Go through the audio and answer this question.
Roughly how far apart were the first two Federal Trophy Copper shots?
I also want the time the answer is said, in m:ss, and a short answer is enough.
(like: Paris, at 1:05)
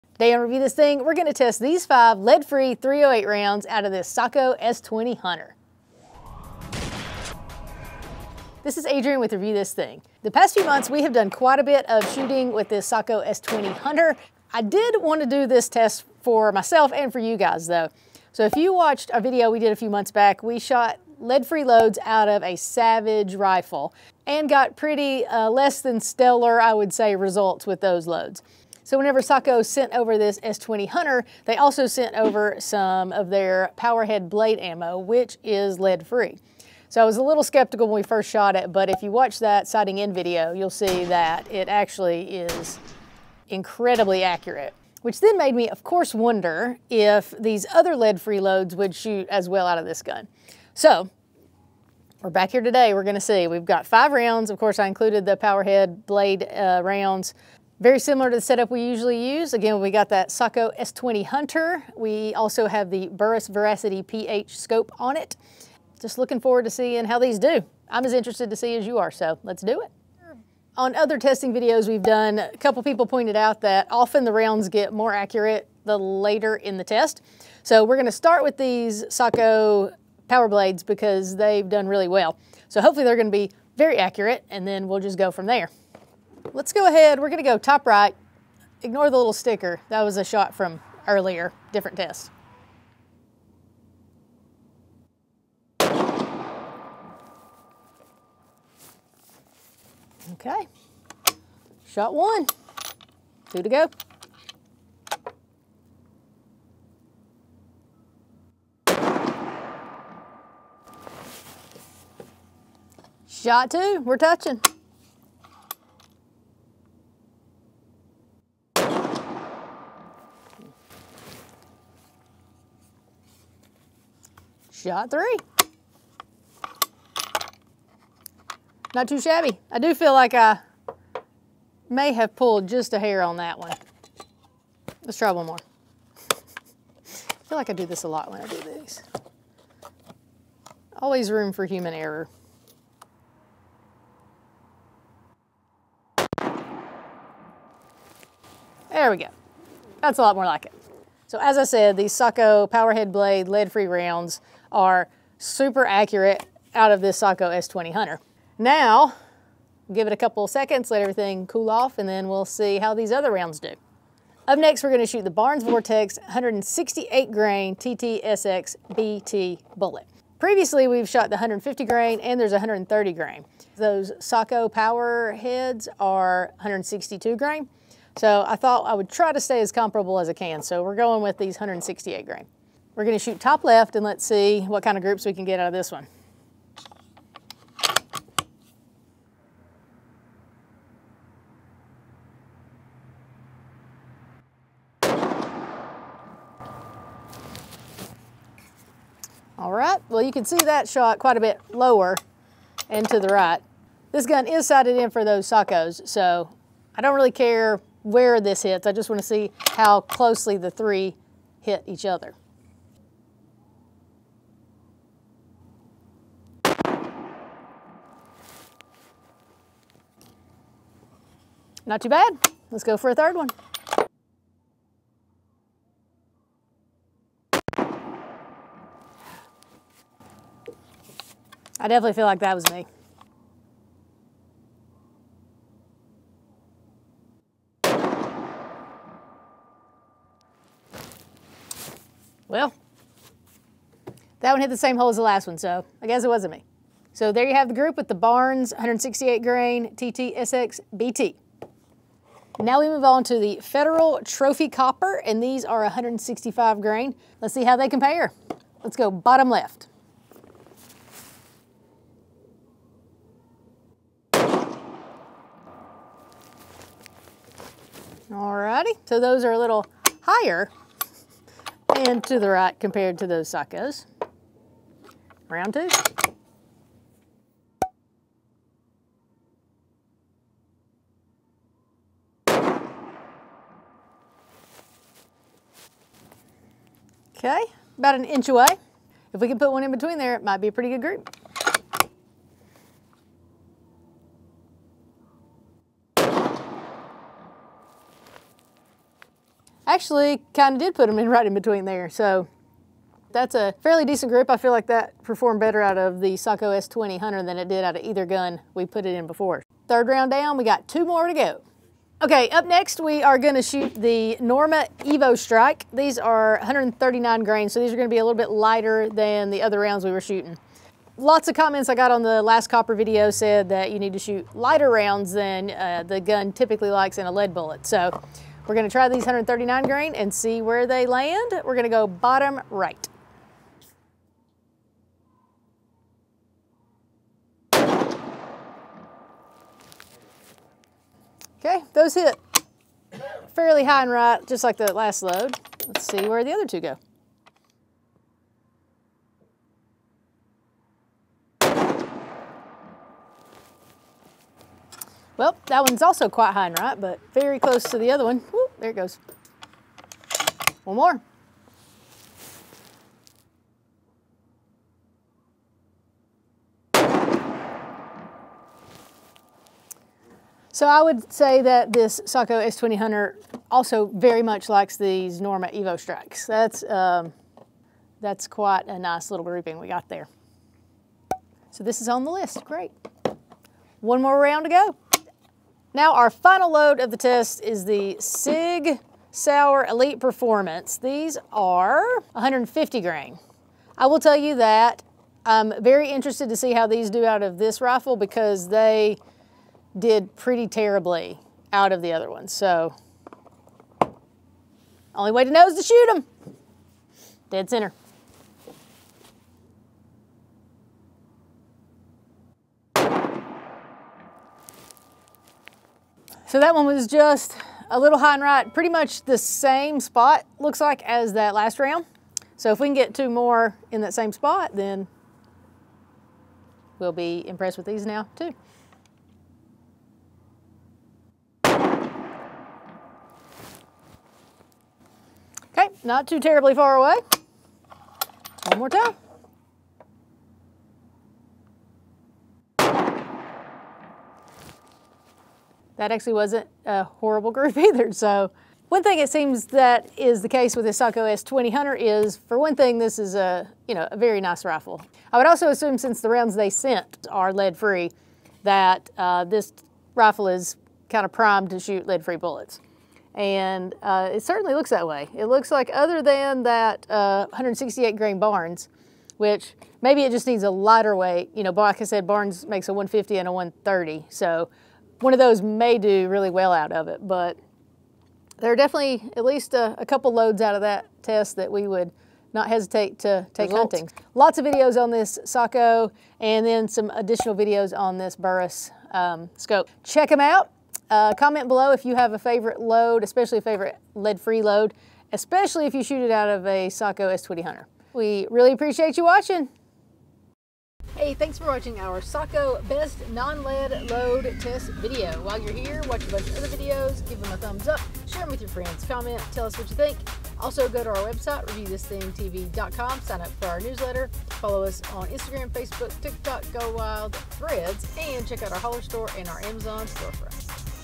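About an inch, at 4:47.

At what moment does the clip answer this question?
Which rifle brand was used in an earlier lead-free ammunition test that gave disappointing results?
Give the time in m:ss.
0:22.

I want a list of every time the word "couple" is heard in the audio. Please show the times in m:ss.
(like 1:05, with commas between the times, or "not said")
1:12, 2:40, 8:00.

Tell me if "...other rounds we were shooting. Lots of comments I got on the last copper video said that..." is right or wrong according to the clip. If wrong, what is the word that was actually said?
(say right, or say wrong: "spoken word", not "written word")
right.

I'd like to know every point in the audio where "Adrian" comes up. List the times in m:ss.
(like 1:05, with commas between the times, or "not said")
0:08.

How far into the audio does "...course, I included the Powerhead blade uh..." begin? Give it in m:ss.
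0:54.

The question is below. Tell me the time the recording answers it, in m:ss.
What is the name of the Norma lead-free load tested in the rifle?
5:14.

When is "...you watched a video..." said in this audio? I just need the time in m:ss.
0:18.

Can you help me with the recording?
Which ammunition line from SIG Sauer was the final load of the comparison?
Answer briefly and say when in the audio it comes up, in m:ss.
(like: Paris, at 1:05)
Elite Performance, at 6:29.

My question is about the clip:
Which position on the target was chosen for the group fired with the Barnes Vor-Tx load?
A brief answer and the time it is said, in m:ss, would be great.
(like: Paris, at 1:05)
Top left, at 3:03.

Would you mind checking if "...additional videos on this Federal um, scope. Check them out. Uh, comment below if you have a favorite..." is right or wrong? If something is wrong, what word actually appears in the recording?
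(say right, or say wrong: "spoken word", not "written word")
wrong: "Burris", not "Federal".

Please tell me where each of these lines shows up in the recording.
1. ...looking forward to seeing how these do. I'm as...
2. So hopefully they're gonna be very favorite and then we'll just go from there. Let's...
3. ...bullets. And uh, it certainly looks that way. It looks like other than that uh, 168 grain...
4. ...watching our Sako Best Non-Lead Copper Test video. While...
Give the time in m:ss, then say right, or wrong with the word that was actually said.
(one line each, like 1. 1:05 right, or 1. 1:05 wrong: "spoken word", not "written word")
1. 1:06 right
2. 1:22 wrong: "accurate", not "favorite"
3. 7:42 right
4. 8:21 wrong: "Load", not "Copper".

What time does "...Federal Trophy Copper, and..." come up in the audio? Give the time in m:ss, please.
4:13.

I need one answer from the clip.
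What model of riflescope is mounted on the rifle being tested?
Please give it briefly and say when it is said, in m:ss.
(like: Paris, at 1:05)
Burris Veracity PH, at 1:03.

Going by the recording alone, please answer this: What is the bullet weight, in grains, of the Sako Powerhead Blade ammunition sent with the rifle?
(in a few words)
162.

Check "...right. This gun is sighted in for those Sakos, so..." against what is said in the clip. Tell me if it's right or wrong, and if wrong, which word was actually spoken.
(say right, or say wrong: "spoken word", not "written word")
right.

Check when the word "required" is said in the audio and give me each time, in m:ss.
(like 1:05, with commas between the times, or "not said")
not said.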